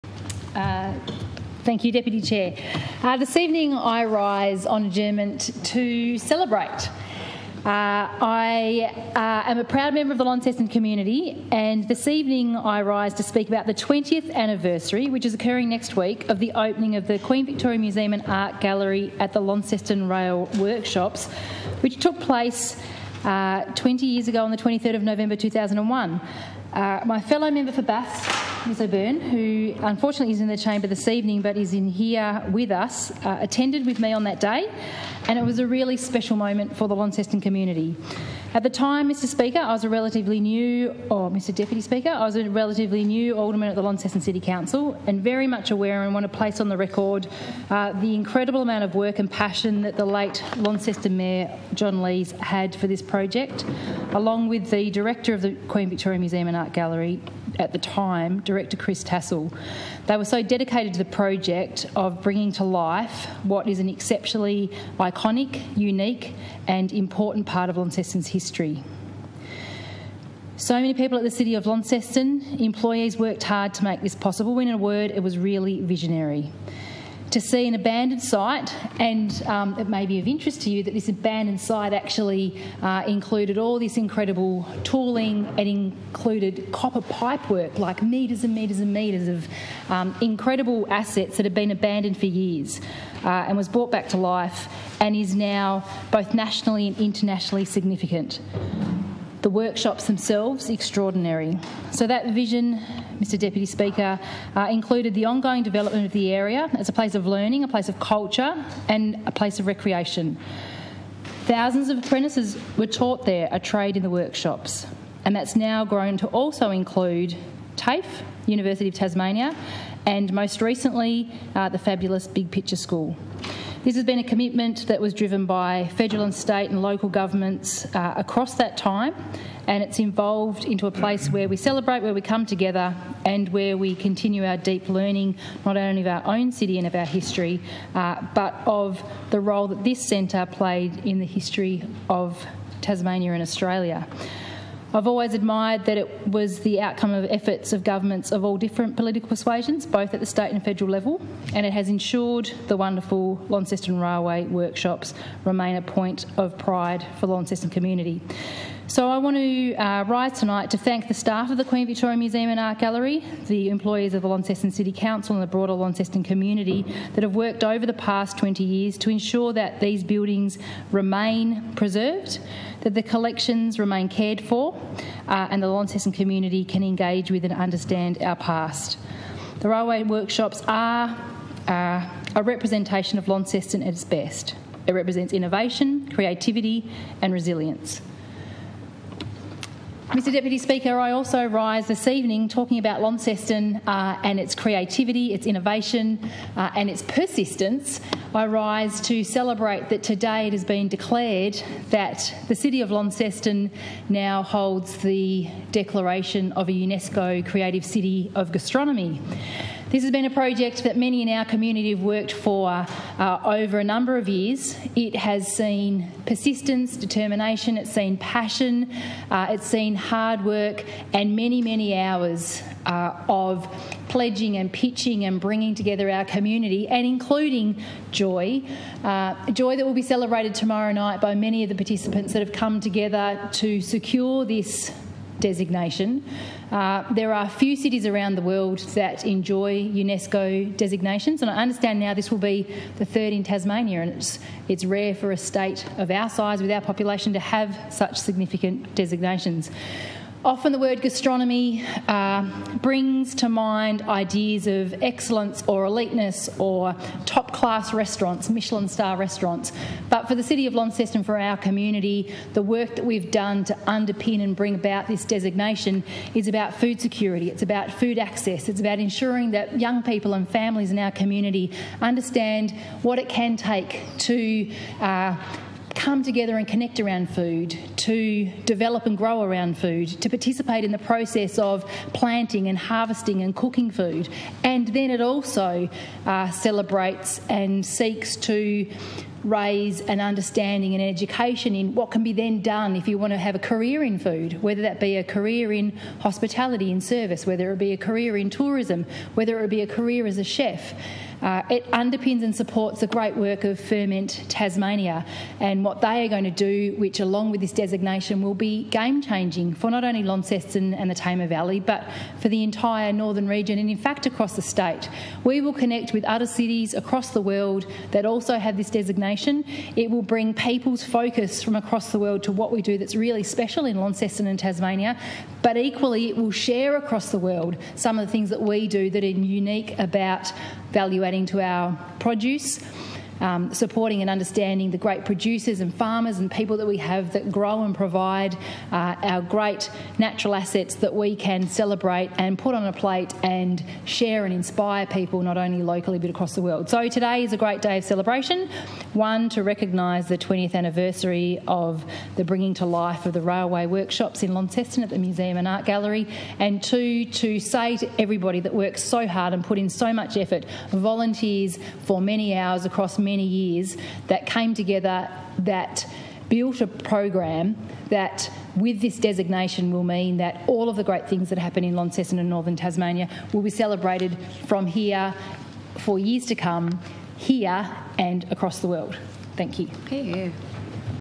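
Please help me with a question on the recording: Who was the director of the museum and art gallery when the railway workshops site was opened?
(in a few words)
Chris Tassell.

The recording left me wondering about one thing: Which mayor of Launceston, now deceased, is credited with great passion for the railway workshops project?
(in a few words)
John Lees.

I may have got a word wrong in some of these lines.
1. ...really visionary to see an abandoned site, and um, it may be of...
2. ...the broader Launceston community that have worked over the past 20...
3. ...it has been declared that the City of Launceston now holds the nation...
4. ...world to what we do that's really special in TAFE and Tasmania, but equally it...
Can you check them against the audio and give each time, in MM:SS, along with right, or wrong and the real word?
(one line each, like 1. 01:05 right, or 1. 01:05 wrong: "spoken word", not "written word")
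1. 01:15 right
2. 02:45 right
3. 03:20 wrong: "declaration", not "nation"
4. 05:22 wrong: "Launceston", not "TAFE".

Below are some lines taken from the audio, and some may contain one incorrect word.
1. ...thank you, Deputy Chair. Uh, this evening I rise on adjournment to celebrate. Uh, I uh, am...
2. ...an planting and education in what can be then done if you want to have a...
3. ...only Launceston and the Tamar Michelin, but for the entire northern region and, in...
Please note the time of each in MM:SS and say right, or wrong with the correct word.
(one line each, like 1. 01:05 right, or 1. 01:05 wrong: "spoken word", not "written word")
1. 00:01 right
2. 04:50 wrong: "understanding", not "planting"
3. 05:10 wrong: "Valley", not "Michelin".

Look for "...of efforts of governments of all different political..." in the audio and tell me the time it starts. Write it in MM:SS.
02:27.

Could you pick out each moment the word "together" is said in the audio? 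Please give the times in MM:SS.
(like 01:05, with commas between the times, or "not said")
02:12, 03:45, 03:52, 04:36, 06:04.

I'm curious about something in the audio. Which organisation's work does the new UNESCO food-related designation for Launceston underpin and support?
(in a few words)
Ferment Tasmania.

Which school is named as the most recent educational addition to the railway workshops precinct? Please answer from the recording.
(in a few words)
Big Picture School.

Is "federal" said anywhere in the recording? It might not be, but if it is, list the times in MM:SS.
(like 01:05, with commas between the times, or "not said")
02:05, 02:30.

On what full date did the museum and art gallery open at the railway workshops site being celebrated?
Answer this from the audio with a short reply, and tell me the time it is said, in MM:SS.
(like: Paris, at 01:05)
23 November 2001, at 00:24.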